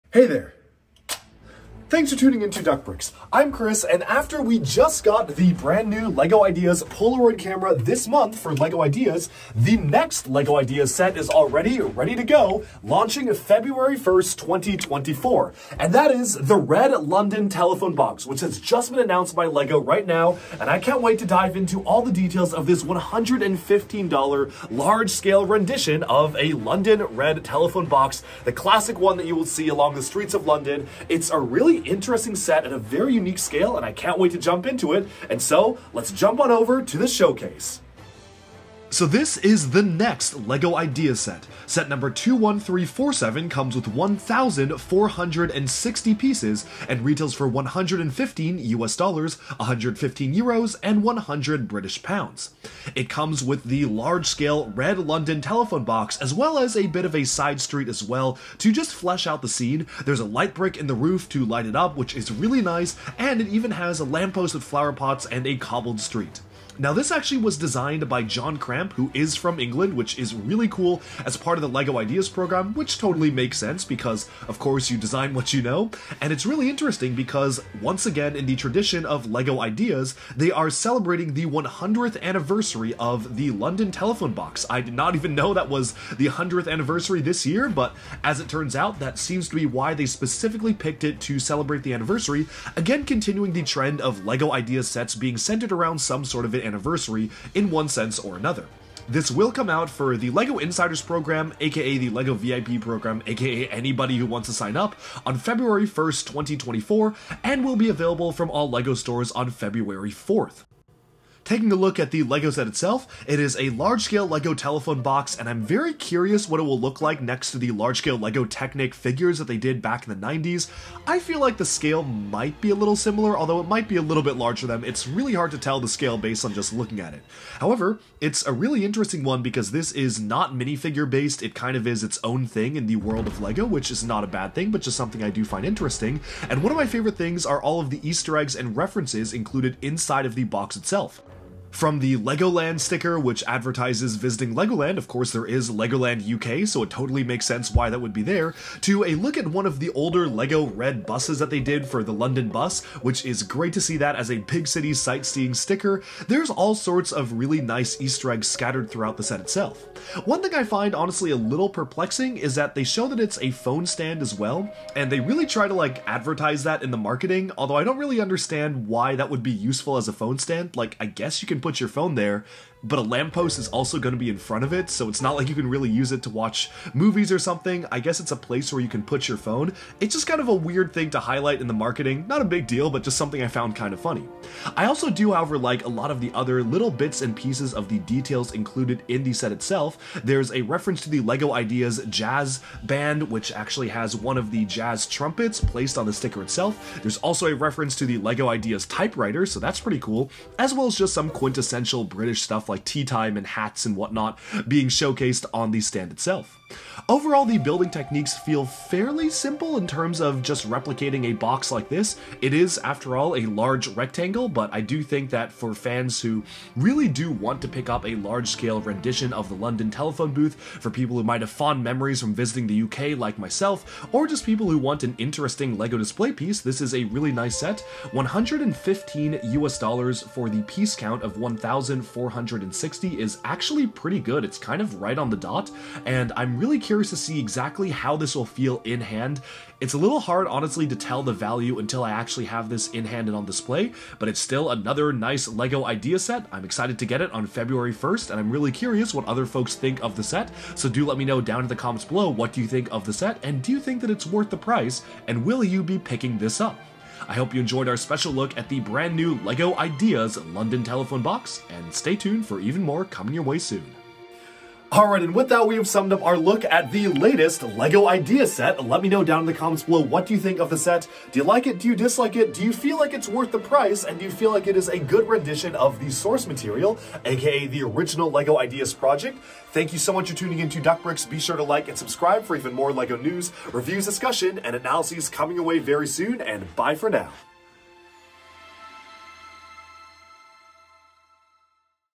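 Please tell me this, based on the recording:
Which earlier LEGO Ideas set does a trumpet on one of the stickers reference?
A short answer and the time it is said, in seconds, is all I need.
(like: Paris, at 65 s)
Jazz Band, at 191 s.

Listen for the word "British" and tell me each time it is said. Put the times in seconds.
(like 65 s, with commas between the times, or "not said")
51 s, 202 s.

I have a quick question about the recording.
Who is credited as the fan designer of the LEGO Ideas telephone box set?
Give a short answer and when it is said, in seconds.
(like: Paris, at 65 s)
John Cramp, at 68 s.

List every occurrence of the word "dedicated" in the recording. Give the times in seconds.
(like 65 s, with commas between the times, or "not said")
not said.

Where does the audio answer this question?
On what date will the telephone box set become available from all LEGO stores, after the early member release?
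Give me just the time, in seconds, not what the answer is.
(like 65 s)
109 s.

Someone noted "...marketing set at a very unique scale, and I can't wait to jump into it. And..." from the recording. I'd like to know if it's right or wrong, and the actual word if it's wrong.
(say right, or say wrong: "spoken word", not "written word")
wrong: "interesting", not "marketing".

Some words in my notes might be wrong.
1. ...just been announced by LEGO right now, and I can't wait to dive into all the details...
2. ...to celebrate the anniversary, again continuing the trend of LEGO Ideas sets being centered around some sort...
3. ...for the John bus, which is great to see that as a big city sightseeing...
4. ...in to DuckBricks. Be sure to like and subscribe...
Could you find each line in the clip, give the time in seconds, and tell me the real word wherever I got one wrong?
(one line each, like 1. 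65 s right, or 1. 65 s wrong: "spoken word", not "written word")
1. 18 s right
2. 91 s right
3. 151 s wrong: "London", not "John"
4. 280 s right.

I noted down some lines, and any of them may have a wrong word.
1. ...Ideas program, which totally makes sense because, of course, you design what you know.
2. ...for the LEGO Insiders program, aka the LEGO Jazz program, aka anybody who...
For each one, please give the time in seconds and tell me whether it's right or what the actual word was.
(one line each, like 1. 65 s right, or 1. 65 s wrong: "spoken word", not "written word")
1. 71 s right
2. 99 s wrong: "VIP", not "Jazz".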